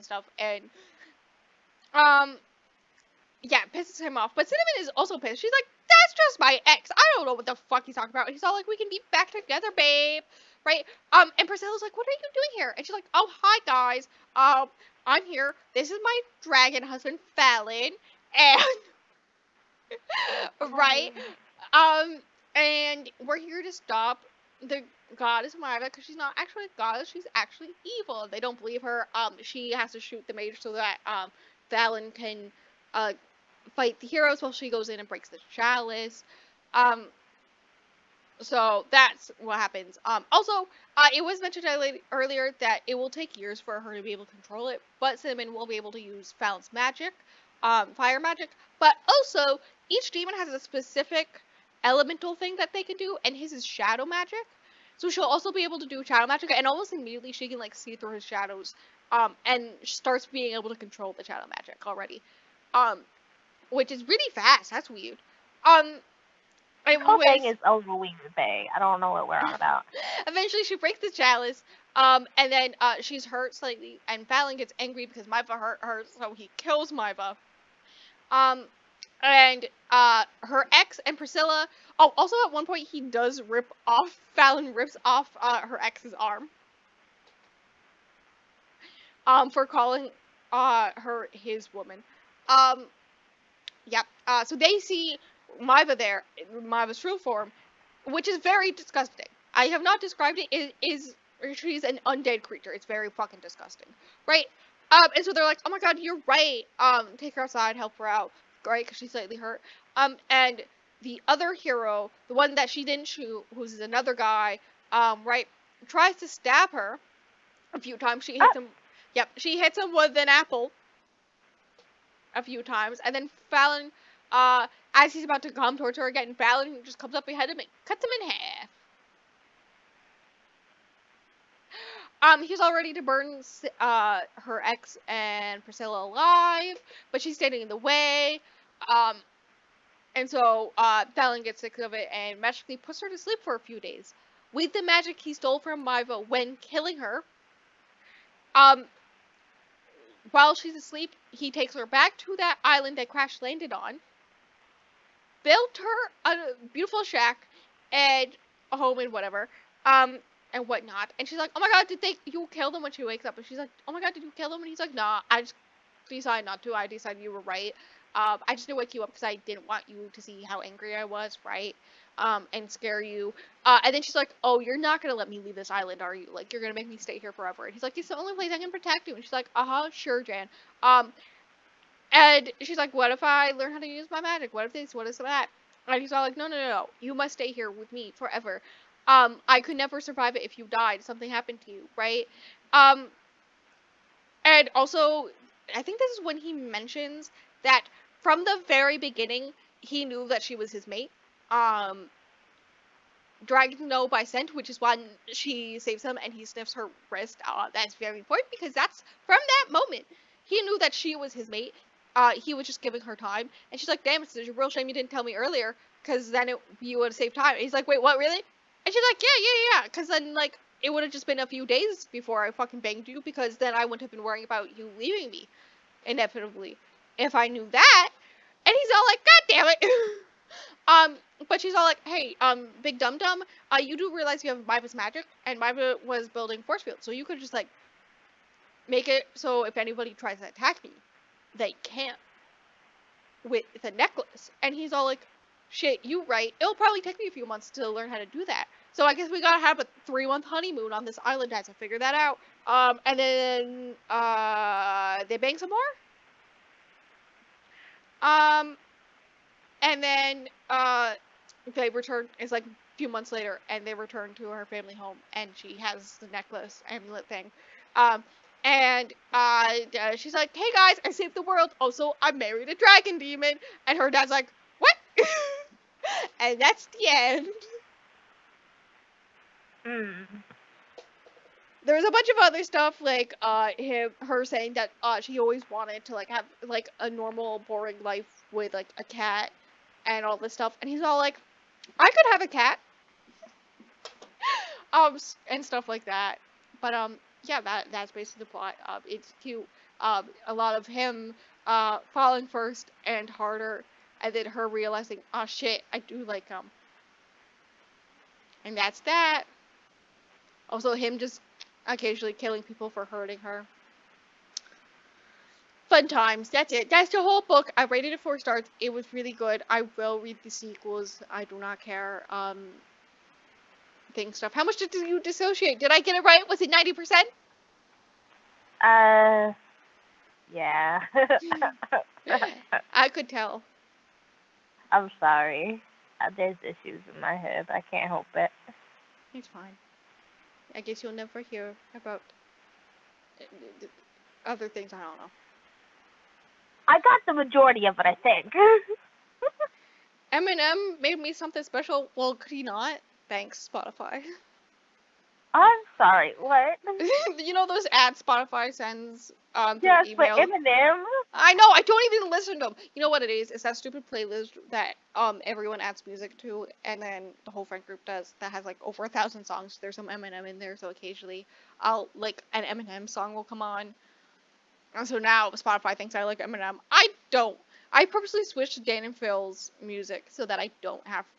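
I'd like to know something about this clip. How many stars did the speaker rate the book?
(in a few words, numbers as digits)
4.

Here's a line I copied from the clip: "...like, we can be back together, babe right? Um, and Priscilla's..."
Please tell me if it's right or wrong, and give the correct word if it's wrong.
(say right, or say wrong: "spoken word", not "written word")
right.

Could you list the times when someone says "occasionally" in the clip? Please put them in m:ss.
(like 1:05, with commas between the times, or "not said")
5:11, 6:10.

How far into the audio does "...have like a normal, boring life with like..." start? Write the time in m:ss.
4:46.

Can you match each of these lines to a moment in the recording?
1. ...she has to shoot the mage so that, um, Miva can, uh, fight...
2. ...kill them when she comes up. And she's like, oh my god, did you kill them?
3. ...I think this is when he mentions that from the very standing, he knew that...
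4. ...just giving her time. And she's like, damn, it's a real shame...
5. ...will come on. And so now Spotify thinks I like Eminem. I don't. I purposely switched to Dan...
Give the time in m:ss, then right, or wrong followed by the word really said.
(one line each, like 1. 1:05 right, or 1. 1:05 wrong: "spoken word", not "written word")
1. 0:29 wrong: "Fallon", not "Miva"
2. 2:42 wrong: "wakes", not "comes"
3. 3:15 wrong: "beginning", not "standing"
4. 3:32 right
5. 6:13 right.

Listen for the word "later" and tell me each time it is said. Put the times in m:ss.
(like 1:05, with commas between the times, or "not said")
4:23.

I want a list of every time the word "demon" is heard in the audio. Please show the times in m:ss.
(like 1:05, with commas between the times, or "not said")
0:50, 4:33.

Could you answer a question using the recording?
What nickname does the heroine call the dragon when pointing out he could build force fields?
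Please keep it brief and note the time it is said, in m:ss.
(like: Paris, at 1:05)
Big Dum Dum, at 3:52.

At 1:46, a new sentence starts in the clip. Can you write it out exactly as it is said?
Um, take her outside, help her out, right?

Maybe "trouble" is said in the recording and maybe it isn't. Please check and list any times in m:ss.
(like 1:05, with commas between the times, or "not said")
not said.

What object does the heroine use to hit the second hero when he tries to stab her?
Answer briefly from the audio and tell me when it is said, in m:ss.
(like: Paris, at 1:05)
An apple, at 2:00.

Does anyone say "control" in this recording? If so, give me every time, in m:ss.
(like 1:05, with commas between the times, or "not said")
0:44, 1:00.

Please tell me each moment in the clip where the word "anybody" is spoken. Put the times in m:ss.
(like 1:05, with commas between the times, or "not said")
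3:59.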